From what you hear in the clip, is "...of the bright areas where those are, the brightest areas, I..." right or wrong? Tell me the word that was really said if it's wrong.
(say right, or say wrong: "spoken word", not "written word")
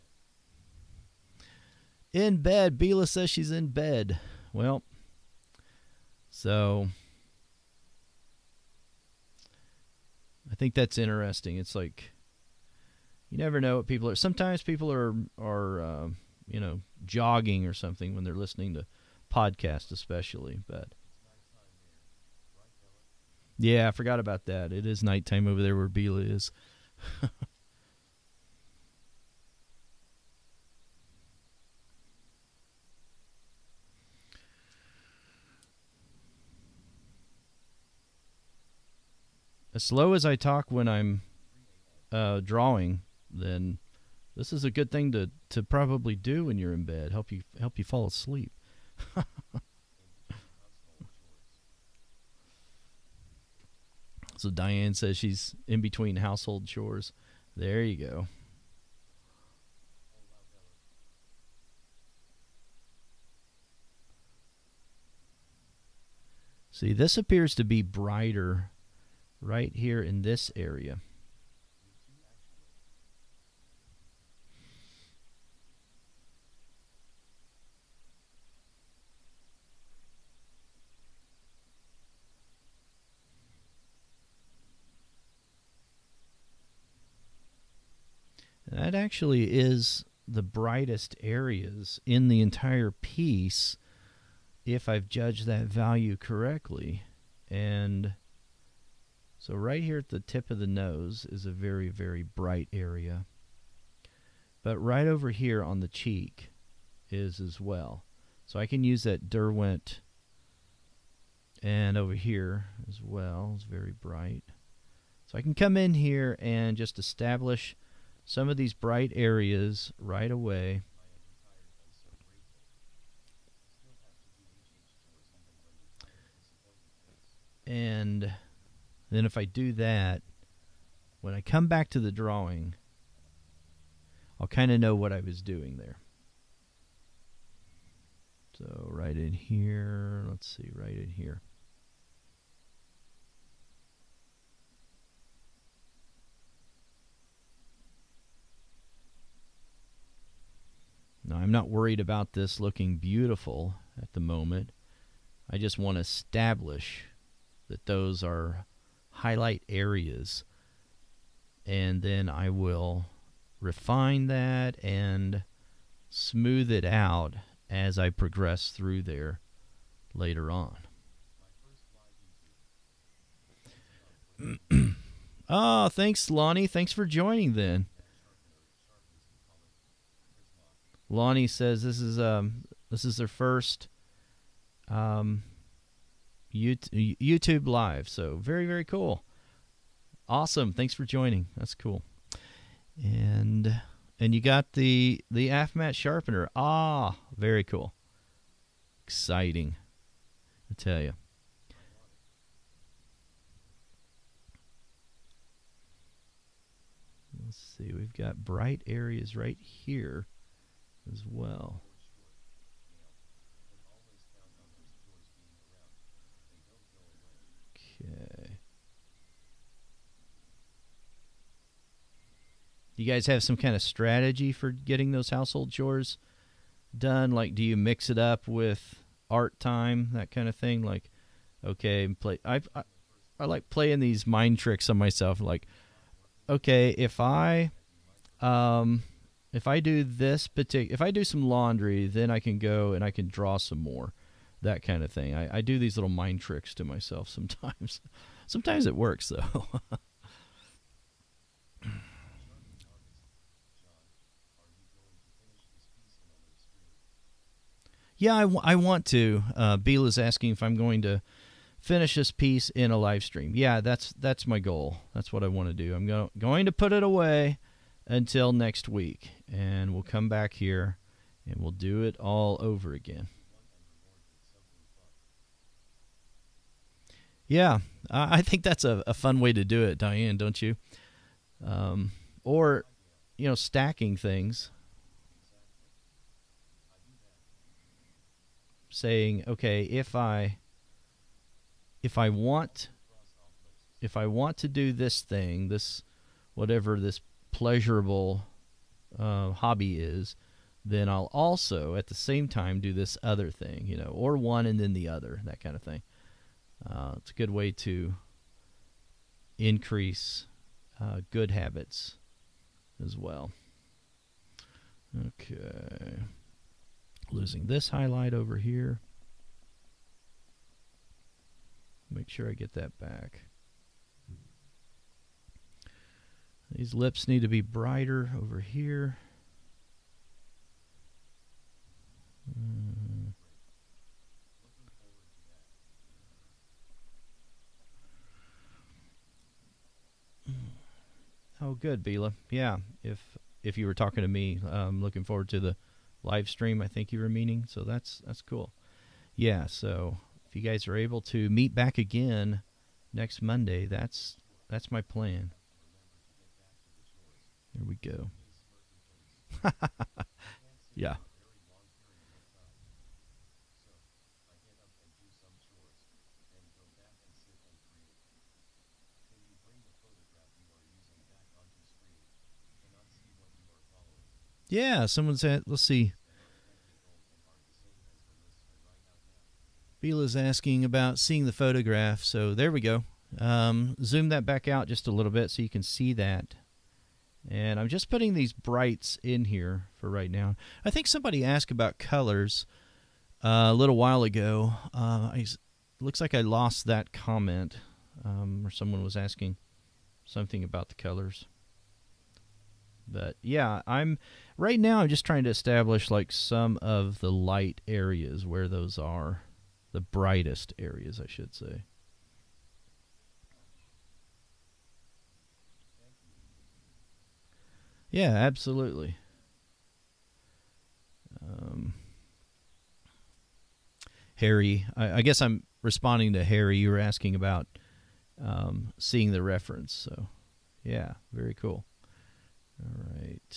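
wrong: "light", not "bright".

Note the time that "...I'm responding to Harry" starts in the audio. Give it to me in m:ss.
7:05.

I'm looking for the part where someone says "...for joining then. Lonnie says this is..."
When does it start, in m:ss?
2:56.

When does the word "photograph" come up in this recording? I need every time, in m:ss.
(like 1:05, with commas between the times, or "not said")
6:21.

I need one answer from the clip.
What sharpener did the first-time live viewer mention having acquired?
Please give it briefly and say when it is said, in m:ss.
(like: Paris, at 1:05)
AFMAT sharpener, at 3:15.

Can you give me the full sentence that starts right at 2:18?
So right in here, let's see, right in here.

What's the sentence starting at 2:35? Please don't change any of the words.
I just want to establish that those are highlight areas.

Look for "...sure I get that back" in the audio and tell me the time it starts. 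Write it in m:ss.
5:22.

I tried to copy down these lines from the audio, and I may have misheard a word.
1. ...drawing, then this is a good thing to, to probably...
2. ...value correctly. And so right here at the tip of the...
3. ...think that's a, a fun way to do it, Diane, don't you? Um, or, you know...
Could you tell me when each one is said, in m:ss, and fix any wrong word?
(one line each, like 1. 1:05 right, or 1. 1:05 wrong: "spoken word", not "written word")
1. 0:42 right
2. 1:35 right
3. 4:38 right.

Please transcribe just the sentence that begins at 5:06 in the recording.
Uh, it's a good way to increase uh, good habits as well.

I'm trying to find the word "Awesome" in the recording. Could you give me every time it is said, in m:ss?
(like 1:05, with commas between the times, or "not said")
3:10.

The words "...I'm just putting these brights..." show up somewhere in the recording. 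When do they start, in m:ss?
6:27.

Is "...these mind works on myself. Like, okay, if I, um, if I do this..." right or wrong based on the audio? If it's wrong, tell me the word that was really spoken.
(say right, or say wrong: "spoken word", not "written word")
wrong: "tricks", not "works".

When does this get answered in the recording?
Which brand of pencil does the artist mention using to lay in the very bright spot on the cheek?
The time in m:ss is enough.
1:49.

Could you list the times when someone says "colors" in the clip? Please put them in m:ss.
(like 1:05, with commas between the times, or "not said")
6:31, 6:40.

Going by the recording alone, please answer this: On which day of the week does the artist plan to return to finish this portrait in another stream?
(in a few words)
Monday.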